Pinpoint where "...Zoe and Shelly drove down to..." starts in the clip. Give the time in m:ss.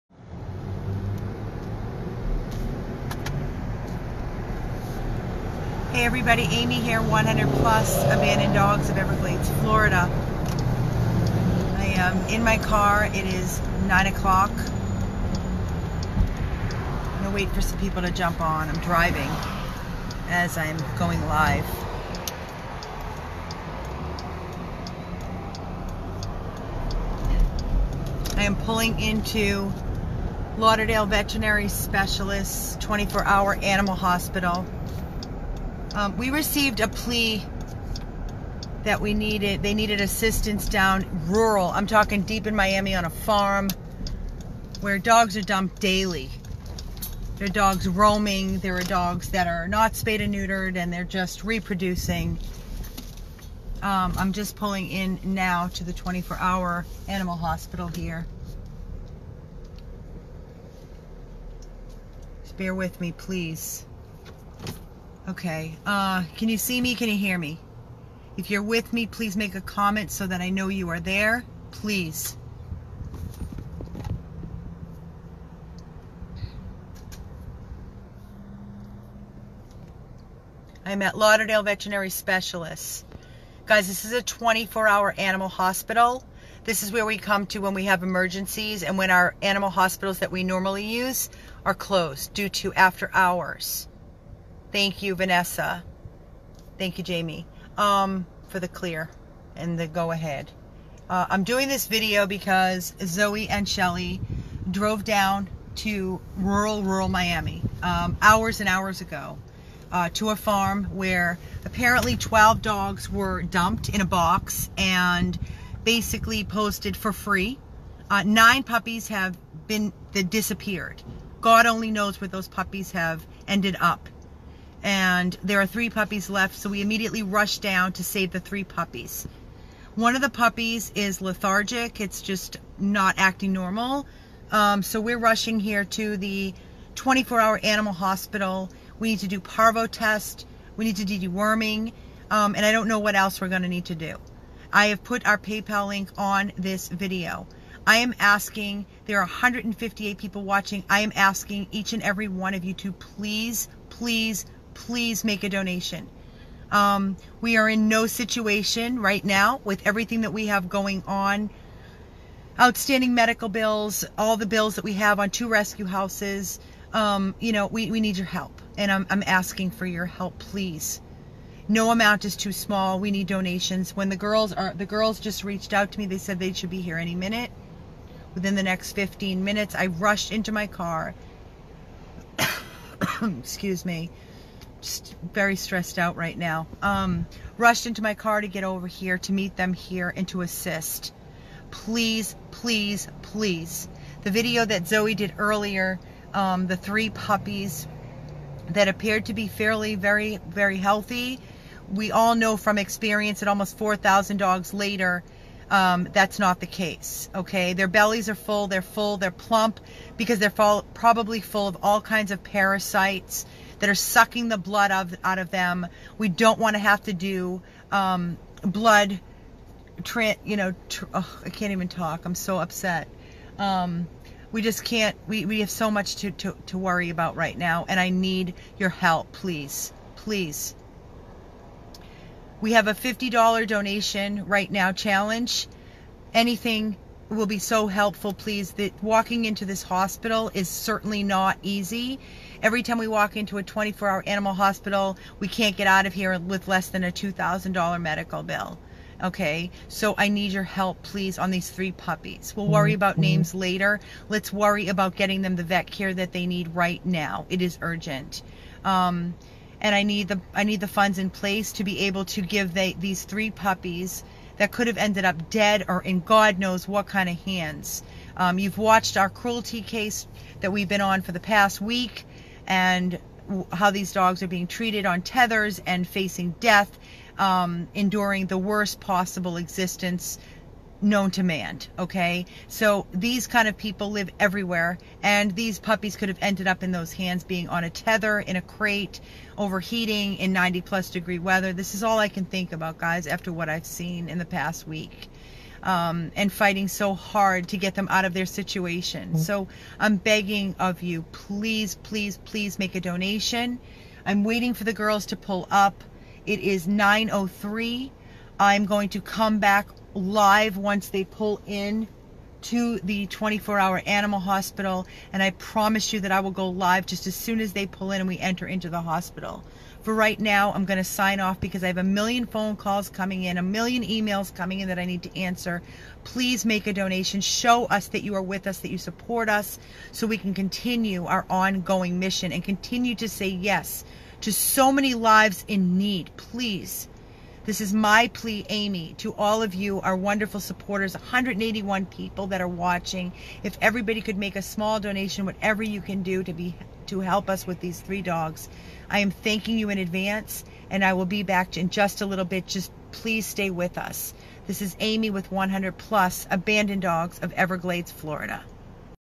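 1:43.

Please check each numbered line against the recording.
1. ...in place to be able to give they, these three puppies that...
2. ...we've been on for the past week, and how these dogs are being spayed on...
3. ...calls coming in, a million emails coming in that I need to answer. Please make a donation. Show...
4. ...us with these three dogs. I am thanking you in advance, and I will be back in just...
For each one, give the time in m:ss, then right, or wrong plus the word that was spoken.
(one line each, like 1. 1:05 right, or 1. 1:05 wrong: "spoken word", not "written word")
1. 4:21 right
2. 4:30 wrong: "treated", not "spayed"
3. 5:22 right
4. 5:47 right.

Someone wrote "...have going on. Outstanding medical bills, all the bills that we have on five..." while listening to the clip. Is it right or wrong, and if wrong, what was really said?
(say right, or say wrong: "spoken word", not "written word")
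wrong: "two", not "five".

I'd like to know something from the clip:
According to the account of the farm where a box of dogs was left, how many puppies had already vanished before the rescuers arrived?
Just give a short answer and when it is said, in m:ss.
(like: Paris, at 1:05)
9, at 1:58.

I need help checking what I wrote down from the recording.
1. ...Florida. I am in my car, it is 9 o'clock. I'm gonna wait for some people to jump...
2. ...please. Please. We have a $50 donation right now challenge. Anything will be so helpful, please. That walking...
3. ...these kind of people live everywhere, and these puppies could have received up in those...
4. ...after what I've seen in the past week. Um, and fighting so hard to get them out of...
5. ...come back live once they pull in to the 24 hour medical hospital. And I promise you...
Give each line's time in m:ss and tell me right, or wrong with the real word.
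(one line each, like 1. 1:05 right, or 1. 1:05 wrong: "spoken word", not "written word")
1. 0:09 right
2. 3:49 right
3. 4:43 wrong: "ended", not "received"
4. 4:53 right
5. 5:09 wrong: "animal", not "medical".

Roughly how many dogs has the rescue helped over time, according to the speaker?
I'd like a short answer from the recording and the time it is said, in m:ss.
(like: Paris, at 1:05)
4,000, at 3:23.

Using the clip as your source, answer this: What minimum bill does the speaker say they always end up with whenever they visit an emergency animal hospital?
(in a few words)
$2,000.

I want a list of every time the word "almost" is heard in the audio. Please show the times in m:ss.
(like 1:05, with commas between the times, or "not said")
3:23.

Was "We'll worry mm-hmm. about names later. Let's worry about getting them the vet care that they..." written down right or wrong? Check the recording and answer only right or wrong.
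right.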